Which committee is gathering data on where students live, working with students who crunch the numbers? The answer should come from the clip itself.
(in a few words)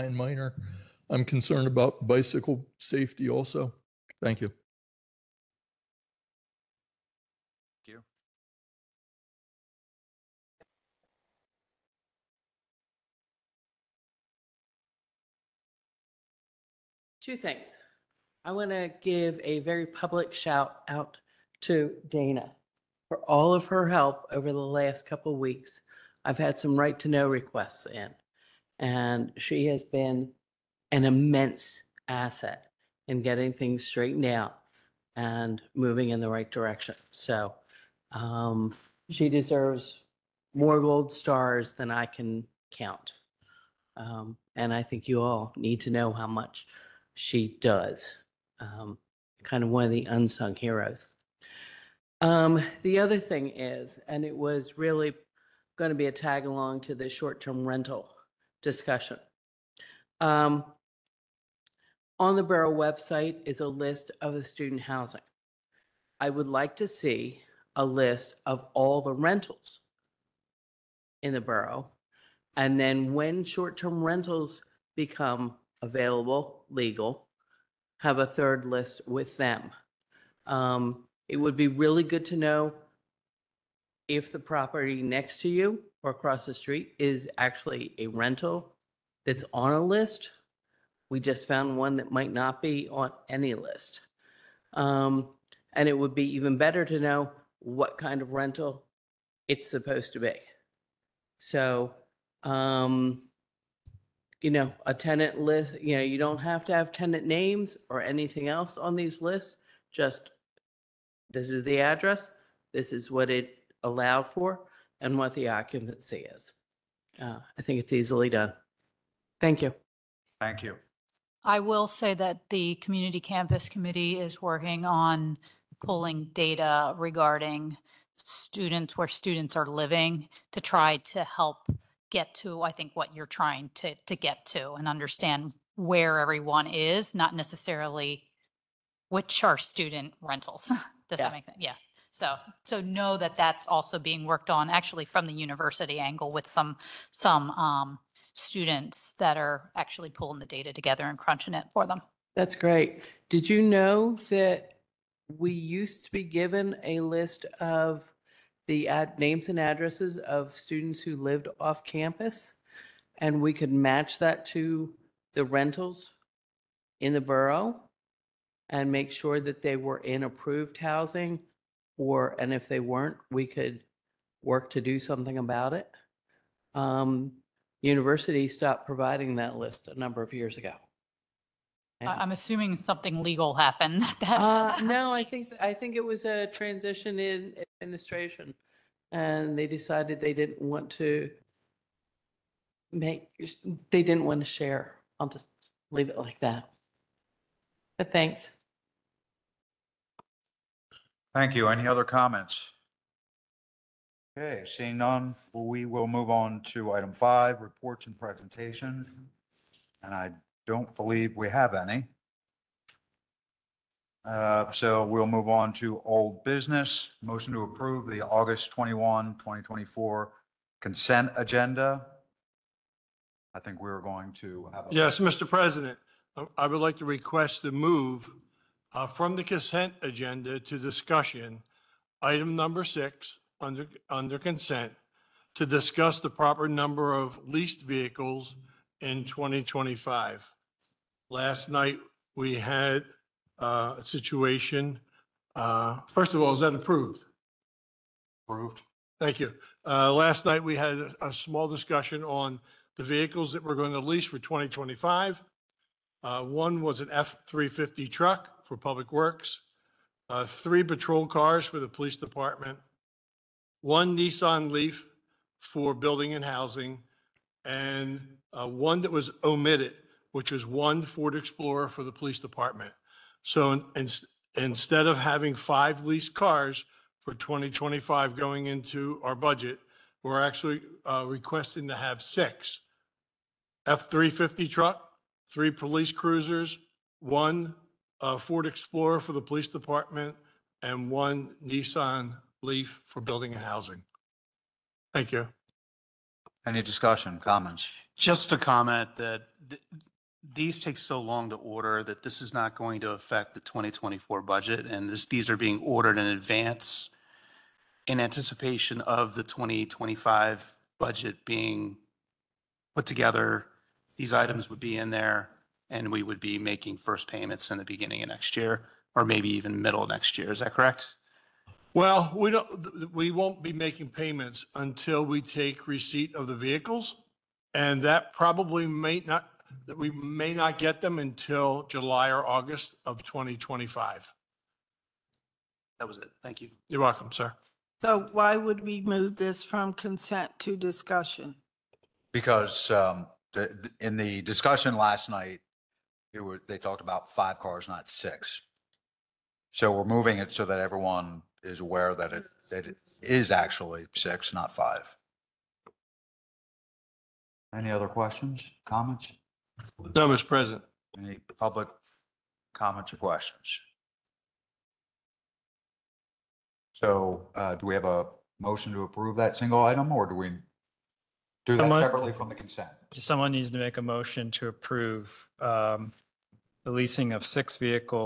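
Community Campus Committee.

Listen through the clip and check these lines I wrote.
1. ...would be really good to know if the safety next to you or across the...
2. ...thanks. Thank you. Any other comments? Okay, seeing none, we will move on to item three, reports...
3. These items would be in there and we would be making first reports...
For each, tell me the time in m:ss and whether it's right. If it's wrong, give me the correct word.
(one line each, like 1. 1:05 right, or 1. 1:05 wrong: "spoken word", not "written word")
1. 1:21 wrong: "property", not "safety"
2. 3:18 wrong: "five", not "three"
3. 5:14 wrong: "payments", not "reports".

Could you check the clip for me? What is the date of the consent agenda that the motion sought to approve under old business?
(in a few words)
August 21, 2024.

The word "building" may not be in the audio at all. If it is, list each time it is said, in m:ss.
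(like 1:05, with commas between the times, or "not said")
4:25, 4:53.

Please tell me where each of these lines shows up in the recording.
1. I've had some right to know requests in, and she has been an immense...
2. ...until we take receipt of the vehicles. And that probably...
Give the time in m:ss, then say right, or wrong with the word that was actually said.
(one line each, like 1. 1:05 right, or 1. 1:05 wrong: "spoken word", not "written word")
1. 0:26 right
2. 5:24 right.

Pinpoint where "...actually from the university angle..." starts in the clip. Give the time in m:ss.
2:24.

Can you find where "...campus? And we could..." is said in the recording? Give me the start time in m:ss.
2:41.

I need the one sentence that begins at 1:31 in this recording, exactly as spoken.
We just found one that might not be on any list.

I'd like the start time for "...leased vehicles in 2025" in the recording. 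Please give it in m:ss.
3:57.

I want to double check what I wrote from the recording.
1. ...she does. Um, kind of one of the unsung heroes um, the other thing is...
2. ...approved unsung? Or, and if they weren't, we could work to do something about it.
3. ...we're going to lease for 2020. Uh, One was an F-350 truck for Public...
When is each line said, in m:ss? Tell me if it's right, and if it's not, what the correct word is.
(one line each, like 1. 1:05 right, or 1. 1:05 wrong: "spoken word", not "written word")
1. 0:47 right
2. 2:50 wrong: "housing", not "unsung"
3. 4:13 wrong: "2025", not "2020".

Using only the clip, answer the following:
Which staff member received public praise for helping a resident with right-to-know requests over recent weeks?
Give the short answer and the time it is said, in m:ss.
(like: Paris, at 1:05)
Dana, at 0:22.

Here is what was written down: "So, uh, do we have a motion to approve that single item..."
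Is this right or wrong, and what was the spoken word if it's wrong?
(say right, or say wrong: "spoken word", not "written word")
right.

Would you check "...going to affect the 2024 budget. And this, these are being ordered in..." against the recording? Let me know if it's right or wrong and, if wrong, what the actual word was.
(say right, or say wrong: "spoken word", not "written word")
right.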